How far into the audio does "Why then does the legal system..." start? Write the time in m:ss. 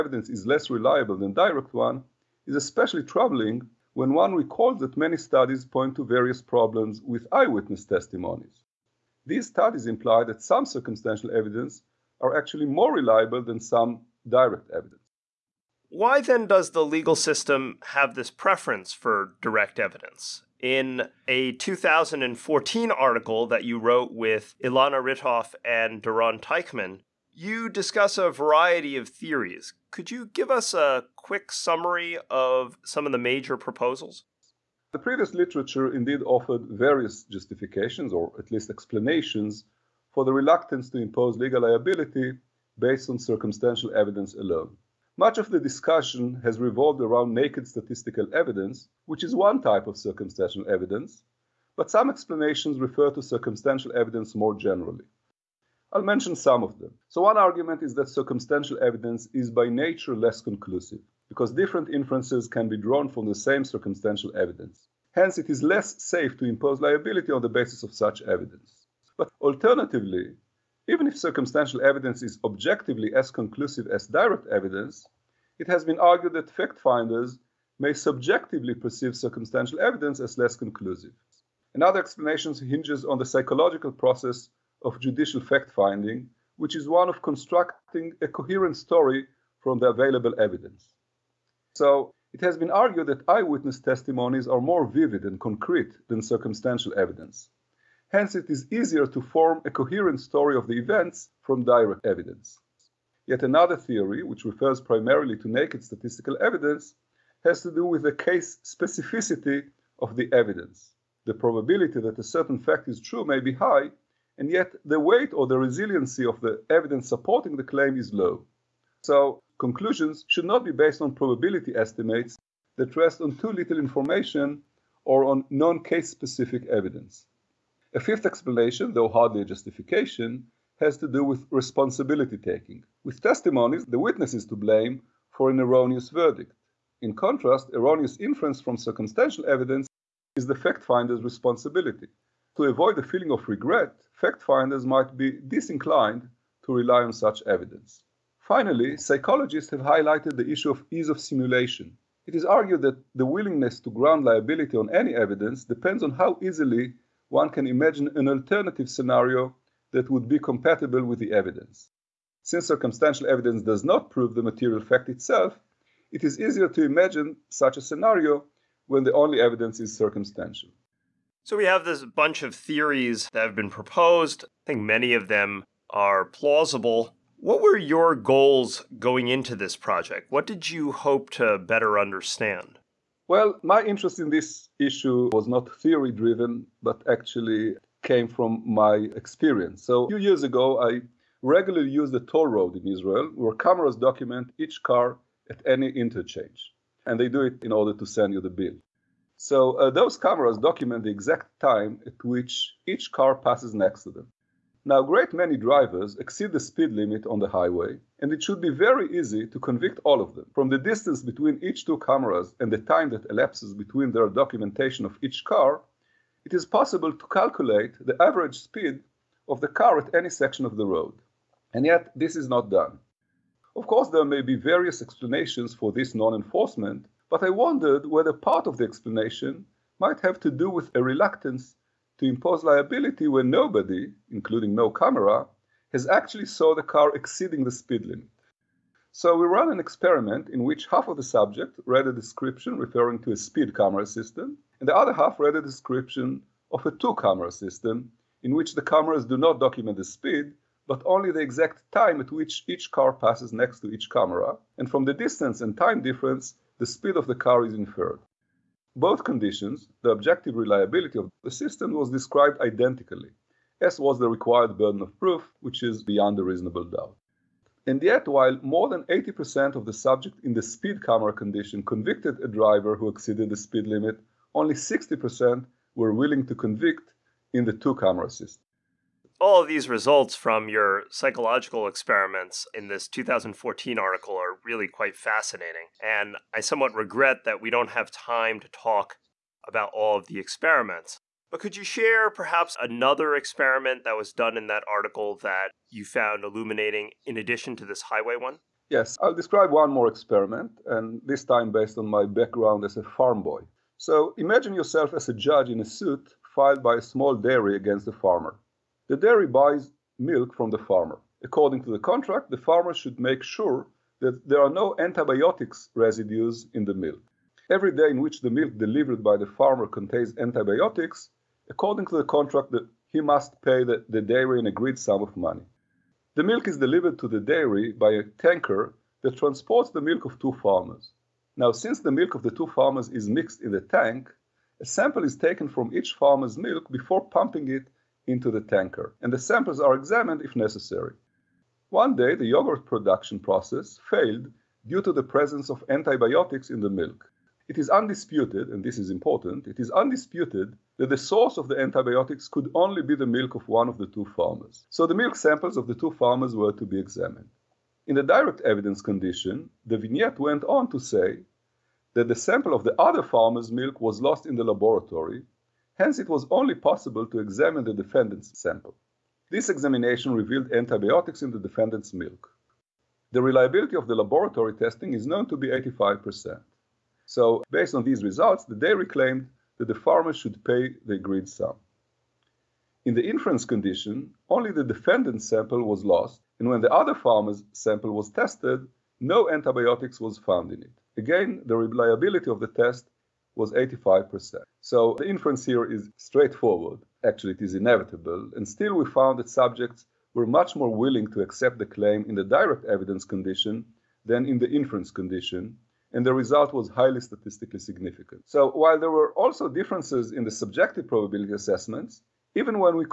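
0:15.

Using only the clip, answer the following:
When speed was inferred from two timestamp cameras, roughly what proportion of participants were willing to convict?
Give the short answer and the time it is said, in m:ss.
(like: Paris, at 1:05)
60%, at 4:34.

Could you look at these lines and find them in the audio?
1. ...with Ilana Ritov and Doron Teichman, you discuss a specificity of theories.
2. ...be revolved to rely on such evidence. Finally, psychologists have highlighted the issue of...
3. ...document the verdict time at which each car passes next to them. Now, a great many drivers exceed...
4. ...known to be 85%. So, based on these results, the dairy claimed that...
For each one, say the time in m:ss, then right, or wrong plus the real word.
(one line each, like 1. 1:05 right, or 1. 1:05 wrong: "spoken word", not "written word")
1. 0:24 wrong: "variety", not "specificity"
2. 2:25 wrong: "disinclined", not "revolved"
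3. 3:20 wrong: "exact", not "verdict"
4. 6:15 right.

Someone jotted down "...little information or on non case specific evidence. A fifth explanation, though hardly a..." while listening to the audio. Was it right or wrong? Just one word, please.
right.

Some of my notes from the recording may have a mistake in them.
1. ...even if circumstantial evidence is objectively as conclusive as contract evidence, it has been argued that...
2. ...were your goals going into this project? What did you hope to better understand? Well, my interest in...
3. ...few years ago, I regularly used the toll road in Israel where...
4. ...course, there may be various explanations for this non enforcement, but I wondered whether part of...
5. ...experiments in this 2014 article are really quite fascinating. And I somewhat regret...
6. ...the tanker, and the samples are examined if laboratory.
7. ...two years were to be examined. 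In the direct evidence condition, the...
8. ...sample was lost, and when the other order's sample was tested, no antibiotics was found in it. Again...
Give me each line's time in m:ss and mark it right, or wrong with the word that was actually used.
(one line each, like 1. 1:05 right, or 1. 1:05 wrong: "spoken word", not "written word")
1. 1:10 wrong: "direct", not "contract"
2. 2:57 right
3. 3:10 right
4. 3:43 right
5. 4:41 right
6. 5:38 wrong: "necessary", not "laboratory"
7. 5:55 wrong: "farmers", not "years"
8. 6:25 wrong: "farmer", not "order".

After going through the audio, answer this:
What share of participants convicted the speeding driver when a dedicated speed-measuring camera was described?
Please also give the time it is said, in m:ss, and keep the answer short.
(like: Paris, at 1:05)
more than 80%, at 4:28.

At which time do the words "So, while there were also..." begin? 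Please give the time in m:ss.
6:48.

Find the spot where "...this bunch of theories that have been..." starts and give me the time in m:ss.
2:51.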